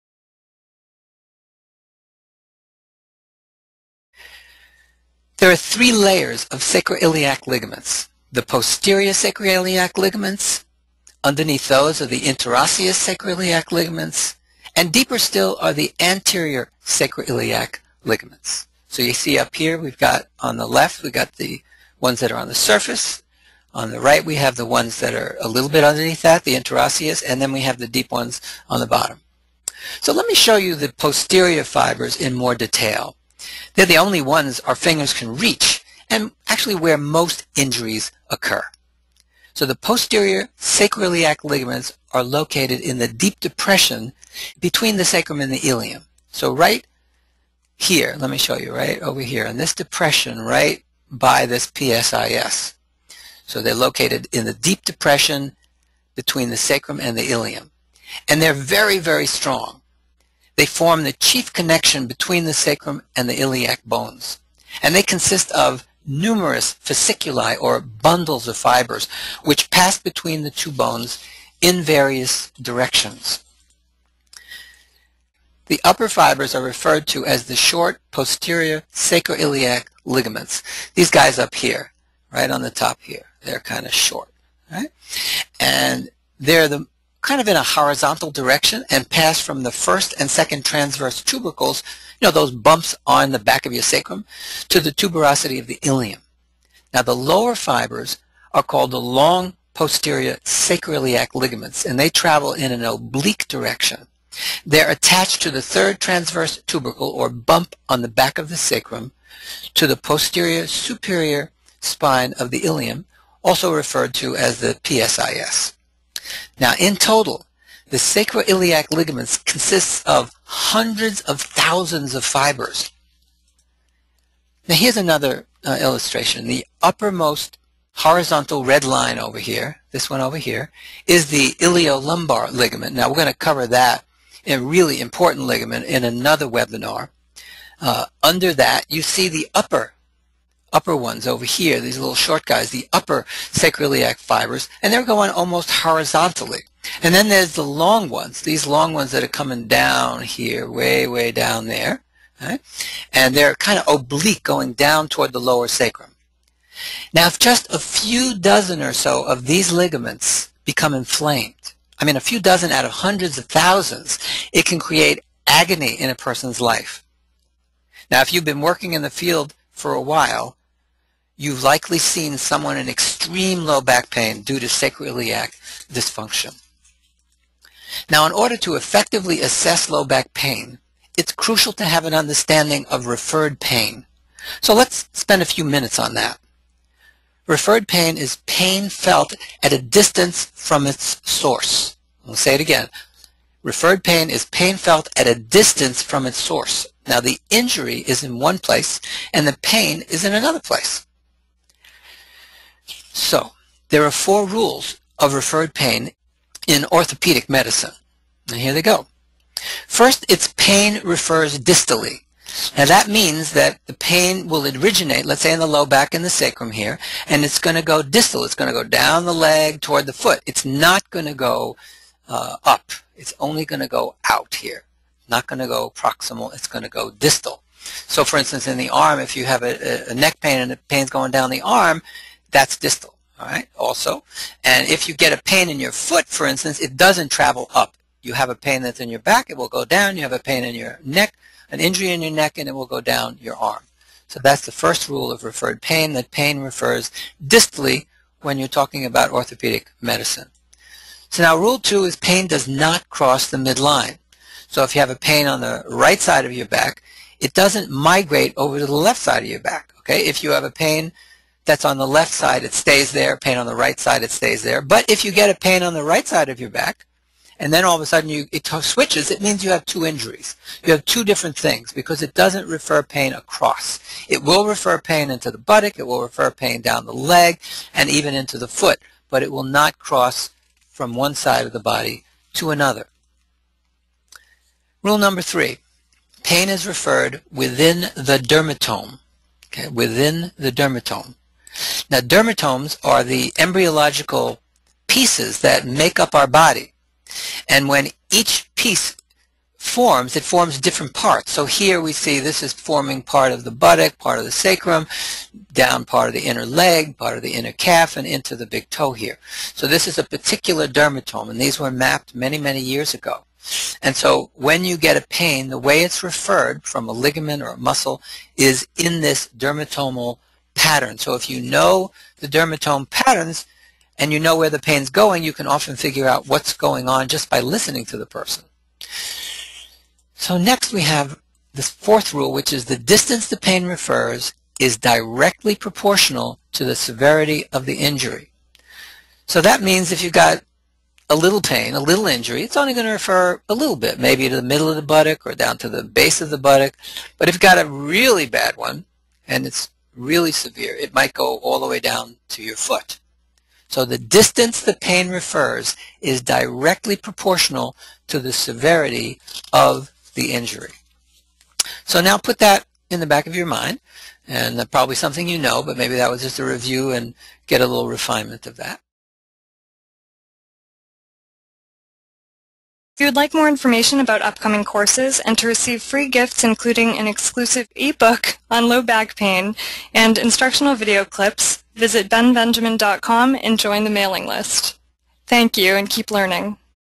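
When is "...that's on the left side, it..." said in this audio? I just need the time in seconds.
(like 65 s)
261 s.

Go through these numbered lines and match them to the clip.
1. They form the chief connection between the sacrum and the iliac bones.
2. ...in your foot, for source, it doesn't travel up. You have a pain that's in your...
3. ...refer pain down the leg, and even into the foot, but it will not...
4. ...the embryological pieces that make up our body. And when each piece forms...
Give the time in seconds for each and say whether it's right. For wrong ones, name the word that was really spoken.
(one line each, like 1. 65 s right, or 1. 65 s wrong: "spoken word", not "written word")
1. 60 s right
2. 235 s wrong: "instance", not "source"
3. 276 s right
4. 293 s right.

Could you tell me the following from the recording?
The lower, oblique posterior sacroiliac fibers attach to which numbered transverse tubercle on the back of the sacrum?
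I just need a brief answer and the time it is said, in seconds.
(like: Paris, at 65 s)
3rd, at 105 s.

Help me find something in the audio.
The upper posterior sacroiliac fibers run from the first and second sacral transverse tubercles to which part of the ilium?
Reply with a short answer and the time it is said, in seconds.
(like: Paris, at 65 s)
Tuberosity of the ilium, at 94 s.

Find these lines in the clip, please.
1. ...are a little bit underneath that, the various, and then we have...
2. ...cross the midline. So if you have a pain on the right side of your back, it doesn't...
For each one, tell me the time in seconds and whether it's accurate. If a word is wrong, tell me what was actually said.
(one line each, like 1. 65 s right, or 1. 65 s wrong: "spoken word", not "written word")
1. 25 s wrong: "interosseous", not "various"
2. 253 s right.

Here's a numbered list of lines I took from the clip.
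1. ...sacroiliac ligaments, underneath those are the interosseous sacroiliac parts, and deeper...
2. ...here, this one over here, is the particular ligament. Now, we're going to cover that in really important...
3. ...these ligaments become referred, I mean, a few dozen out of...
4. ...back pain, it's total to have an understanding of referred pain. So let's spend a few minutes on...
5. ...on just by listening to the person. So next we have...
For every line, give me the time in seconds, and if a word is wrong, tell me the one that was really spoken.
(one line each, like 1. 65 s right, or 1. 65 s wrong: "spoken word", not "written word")
1. 9 s wrong: "ligaments", not "parts"
2. 129 s wrong: "iliolumbar", not "particular"
3. 159 s wrong: "inflamed", not "referred"
4. 180 s wrong: "crucial", not "total"
5. 327 s right.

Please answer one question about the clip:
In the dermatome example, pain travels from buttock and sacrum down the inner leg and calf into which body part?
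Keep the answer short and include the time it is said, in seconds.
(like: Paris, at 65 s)
Big toe, at 308 s.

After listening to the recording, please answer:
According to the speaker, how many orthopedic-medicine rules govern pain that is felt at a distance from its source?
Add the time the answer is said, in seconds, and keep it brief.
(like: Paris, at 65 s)
4, at 204 s.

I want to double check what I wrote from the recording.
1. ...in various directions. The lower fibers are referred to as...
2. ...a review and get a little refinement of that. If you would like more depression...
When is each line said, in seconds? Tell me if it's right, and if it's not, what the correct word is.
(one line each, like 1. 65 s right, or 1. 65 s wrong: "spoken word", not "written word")
1. 71 s wrong: "upper", not "lower"
2. 366 s wrong: "information", not "depression".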